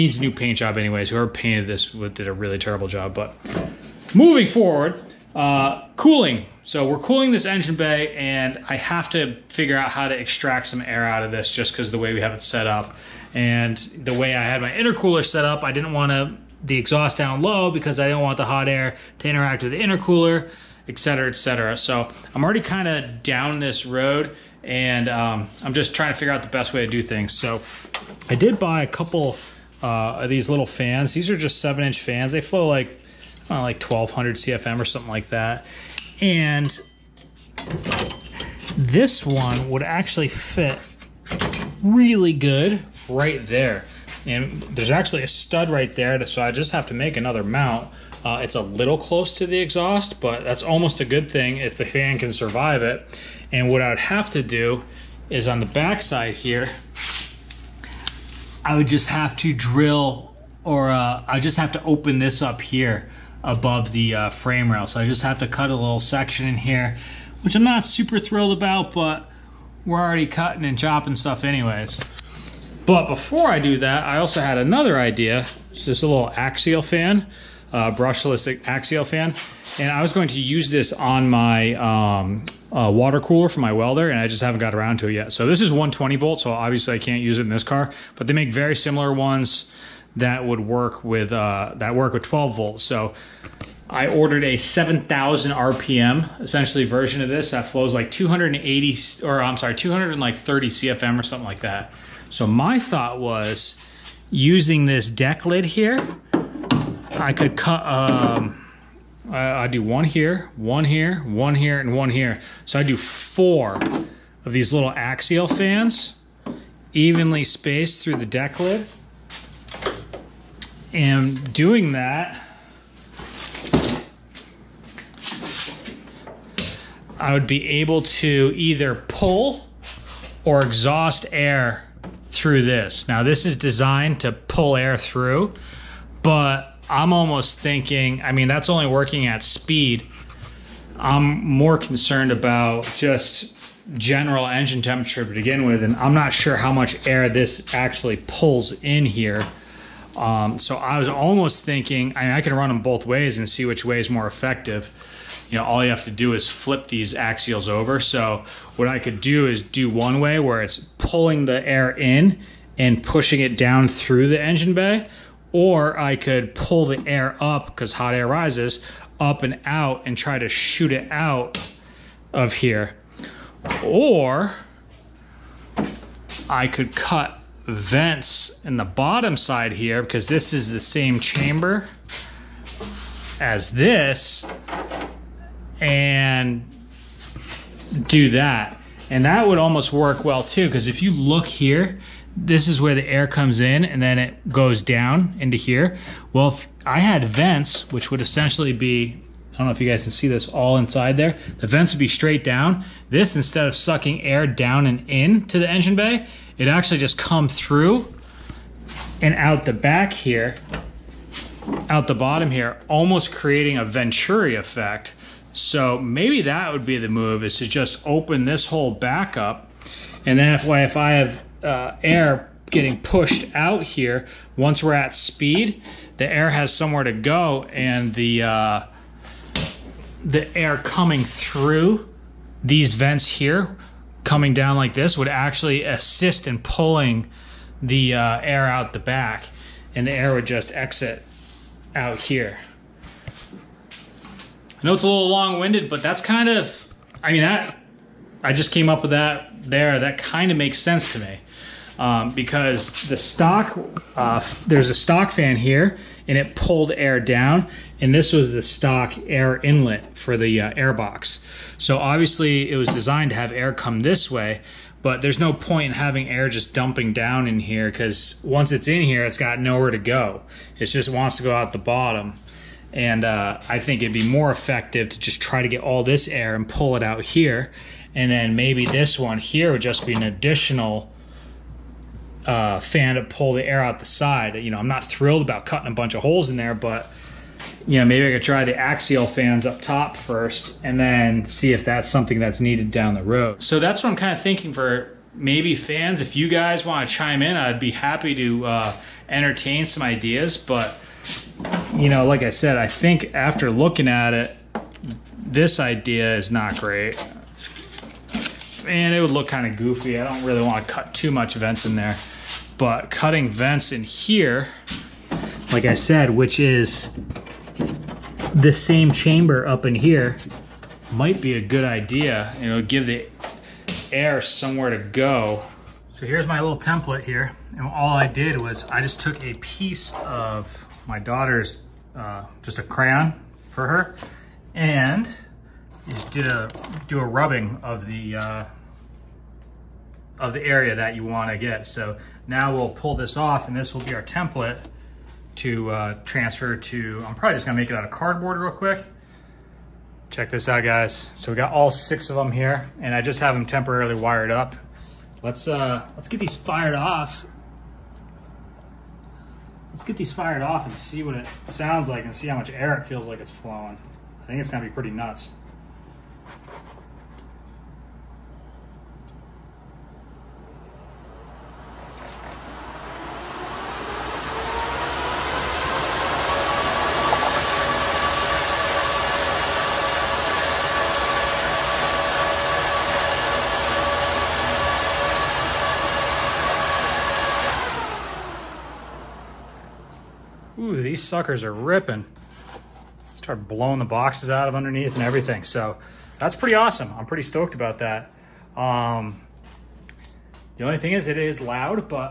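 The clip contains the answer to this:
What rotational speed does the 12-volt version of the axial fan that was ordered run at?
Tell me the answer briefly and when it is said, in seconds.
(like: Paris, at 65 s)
7,000 RPM, at 94 s.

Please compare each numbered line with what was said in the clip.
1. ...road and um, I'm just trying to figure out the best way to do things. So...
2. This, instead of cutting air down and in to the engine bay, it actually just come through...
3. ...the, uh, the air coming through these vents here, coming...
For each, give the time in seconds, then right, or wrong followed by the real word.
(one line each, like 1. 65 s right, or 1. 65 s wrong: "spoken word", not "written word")
1. 23 s right
2. 203 s wrong: "sucking", not "cutting"
3. 228 s right.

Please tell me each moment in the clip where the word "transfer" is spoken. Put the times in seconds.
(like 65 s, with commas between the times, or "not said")
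346 s.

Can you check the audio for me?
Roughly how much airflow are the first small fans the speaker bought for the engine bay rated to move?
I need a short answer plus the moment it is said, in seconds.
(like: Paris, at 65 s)
1200 CFM, at 33 s.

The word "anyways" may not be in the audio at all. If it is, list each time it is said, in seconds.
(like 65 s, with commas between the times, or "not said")
0 s, 71 s.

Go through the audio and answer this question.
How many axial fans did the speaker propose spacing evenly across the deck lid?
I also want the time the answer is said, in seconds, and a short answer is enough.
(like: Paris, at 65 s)
4, at 112 s.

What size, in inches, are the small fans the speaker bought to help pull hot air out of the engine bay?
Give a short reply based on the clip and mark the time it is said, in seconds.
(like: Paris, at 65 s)
7 inch, at 31 s.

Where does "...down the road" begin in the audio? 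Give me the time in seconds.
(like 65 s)
292 s.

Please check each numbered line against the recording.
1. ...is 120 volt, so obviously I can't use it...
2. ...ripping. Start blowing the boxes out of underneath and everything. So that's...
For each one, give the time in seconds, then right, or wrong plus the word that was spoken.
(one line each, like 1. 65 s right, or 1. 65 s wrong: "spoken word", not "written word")
1. 85 s right
2. 391 s right.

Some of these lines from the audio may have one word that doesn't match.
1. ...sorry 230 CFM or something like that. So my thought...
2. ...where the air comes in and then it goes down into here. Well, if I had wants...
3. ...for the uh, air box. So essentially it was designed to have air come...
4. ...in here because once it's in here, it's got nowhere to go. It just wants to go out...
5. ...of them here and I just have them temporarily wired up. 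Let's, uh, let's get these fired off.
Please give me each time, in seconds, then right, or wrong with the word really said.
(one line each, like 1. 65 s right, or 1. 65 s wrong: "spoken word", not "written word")
1. 99 s right
2. 192 s wrong: "vents", not "wants"
3. 260 s wrong: "obviously", not "essentially"
4. 267 s right
5. 352 s right.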